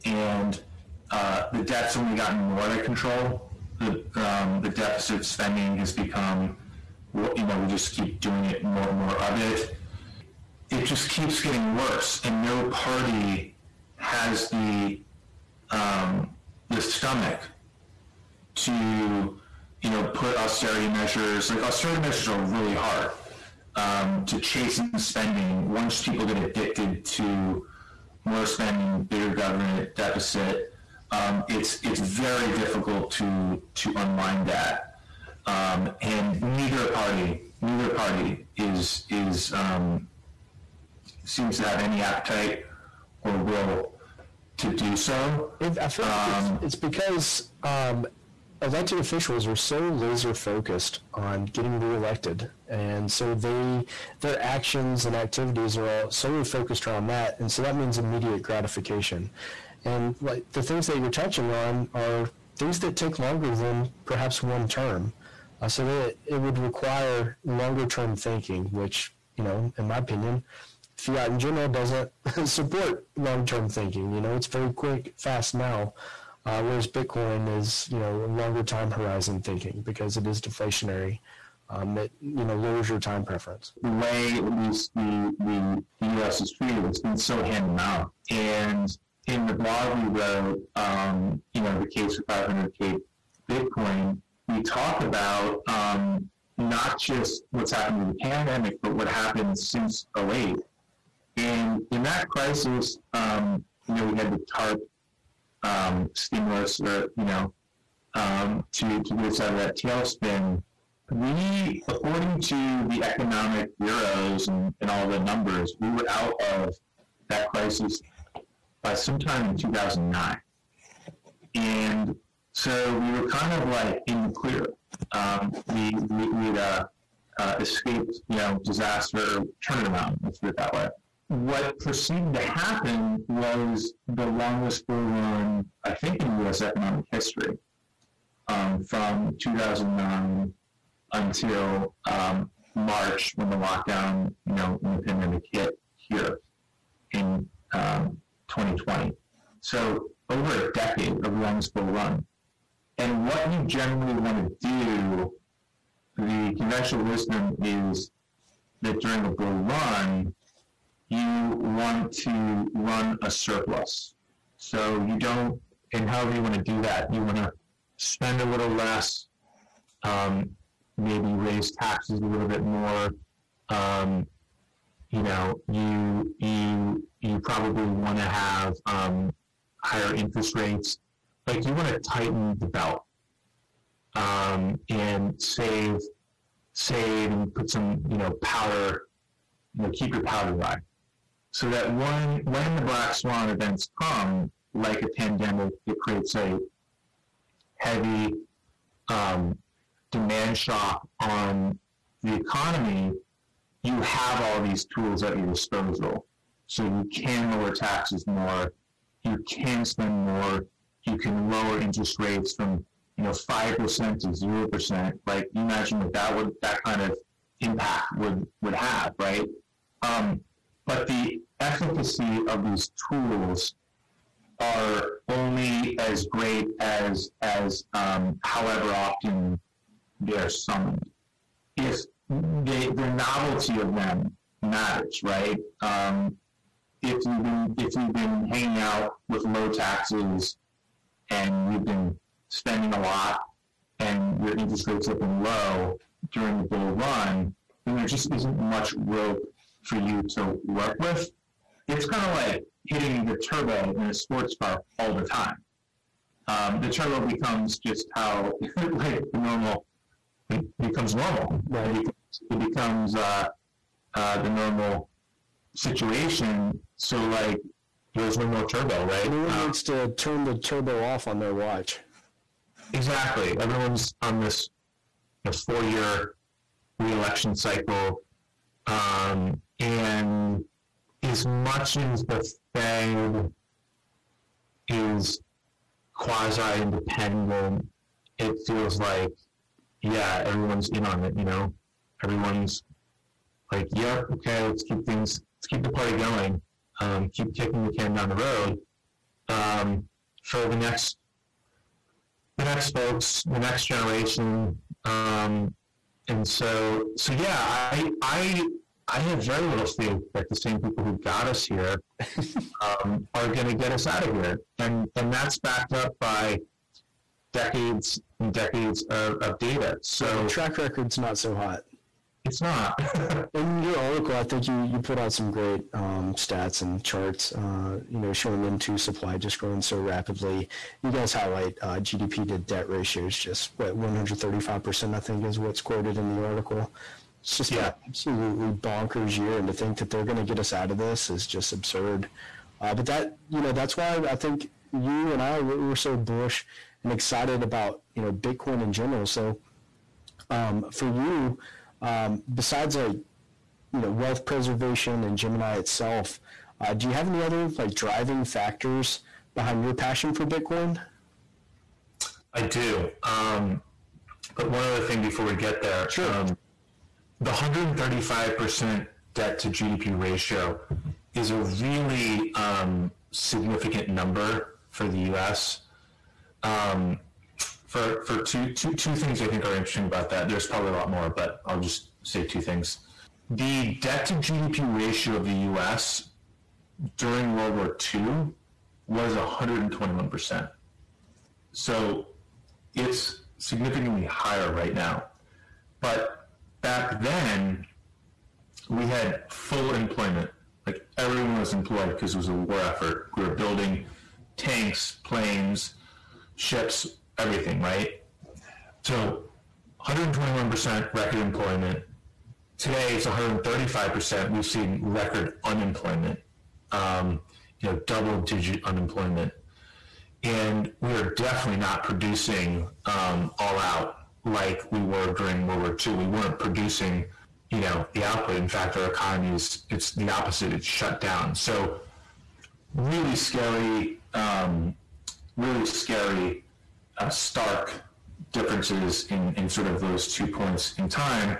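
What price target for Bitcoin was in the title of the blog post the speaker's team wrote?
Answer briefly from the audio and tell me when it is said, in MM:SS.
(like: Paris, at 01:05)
500k, at 01:32.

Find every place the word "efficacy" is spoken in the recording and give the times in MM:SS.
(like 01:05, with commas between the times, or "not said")
03:41.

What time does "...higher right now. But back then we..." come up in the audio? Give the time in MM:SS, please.
06:34.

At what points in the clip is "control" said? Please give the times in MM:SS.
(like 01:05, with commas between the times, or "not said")
00:02.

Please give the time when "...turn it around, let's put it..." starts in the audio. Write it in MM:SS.
02:09.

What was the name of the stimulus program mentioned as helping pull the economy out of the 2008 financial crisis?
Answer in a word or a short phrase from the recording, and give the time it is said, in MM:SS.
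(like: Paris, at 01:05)
TARP, at 01:44.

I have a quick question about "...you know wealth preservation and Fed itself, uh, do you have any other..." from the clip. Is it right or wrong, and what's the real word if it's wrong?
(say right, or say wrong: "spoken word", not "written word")
wrong: "Gemini", not "Fed".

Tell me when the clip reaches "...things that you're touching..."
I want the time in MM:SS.
01:00.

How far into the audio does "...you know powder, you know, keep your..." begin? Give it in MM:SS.
03:08.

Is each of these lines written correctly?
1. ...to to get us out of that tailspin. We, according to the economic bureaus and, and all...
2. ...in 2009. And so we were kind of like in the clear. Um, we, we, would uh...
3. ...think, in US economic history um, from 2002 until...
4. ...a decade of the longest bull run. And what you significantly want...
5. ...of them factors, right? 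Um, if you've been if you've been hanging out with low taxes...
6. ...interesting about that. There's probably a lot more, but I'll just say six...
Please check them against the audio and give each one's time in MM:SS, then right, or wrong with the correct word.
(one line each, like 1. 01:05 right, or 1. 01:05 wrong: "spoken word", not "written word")
1. 01:48 right
2. 01:59 right
3. 02:15 wrong: "2009", not "2002"
4. 02:30 wrong: "generally", not "significantly"
5. 03:53 wrong: "matters", not "factors"
6. 06:19 wrong: "two", not "six".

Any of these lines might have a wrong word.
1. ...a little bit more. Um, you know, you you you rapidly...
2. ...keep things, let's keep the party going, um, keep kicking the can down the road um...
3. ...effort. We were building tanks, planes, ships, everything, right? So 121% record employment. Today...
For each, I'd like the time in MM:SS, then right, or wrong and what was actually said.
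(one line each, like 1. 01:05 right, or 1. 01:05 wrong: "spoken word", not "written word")
1. 02:52 wrong: "probably", not "rapidly"
2. 04:54 right
3. 06:42 right.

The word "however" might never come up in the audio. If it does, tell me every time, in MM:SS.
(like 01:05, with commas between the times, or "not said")
02:46, 03:48.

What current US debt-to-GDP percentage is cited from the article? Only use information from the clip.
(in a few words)
135%.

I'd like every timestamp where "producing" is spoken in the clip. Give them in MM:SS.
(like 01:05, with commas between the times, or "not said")
07:02, 07:06.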